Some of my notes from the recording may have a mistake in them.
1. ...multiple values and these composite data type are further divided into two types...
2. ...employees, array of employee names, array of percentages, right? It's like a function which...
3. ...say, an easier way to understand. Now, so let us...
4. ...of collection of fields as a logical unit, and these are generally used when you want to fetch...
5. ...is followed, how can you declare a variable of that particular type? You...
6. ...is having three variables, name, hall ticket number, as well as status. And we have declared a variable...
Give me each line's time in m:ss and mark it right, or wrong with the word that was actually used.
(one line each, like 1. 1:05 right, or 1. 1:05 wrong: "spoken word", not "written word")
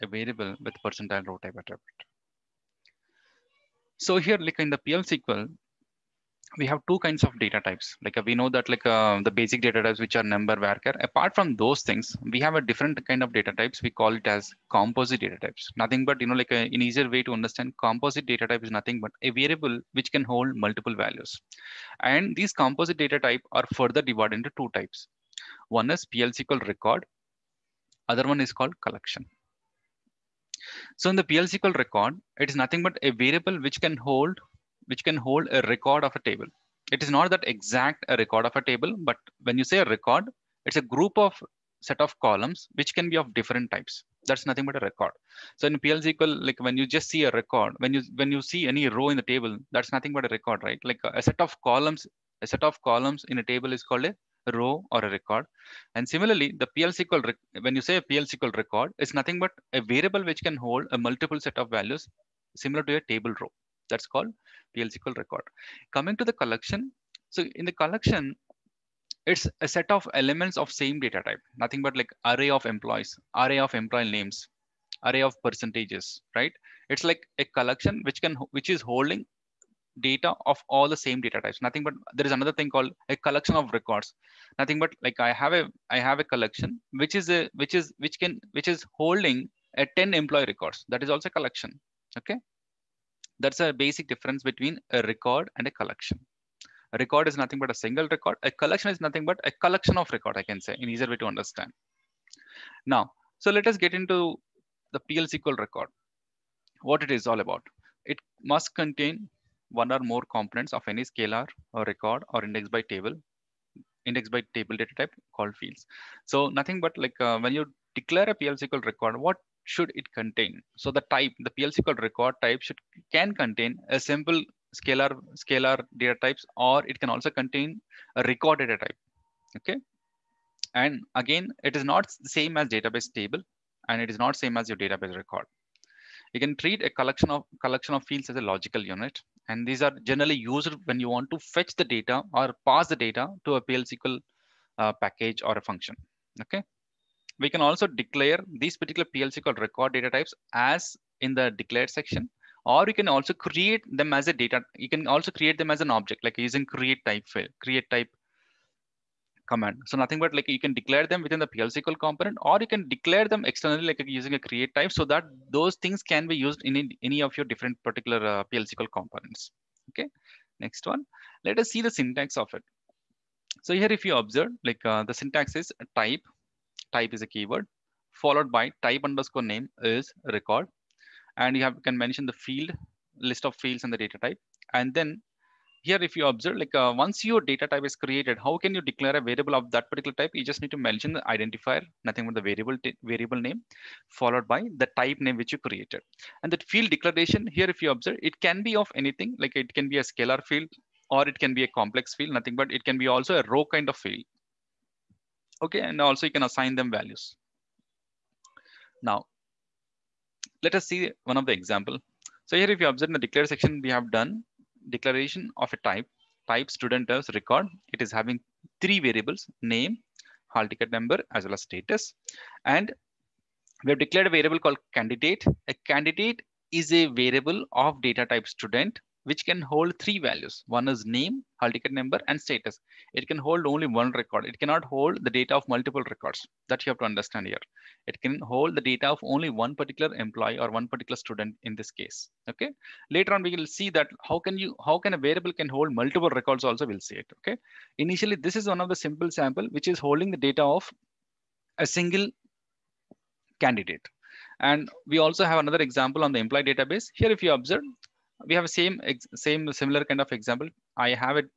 1. 0:20 right
2. 1:12 wrong: "collection", not "function"
3. 1:40 right
4. 2:17 right
5. 3:07 wrong: "created", not "followed"
6. 3:38 right.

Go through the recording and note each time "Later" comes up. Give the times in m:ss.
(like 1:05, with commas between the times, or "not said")
4:03.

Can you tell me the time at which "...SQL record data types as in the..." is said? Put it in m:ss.
2:29.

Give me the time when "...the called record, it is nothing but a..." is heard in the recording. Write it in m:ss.
0:31.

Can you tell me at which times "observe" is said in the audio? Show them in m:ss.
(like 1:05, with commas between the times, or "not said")
2:54, 3:06, 3:17, 3:32, 4:17.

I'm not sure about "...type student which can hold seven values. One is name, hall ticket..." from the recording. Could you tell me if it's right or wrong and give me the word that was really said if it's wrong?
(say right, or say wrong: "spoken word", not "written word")
wrong: "three", not "seven".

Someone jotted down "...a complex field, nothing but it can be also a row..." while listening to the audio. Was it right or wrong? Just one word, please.
right.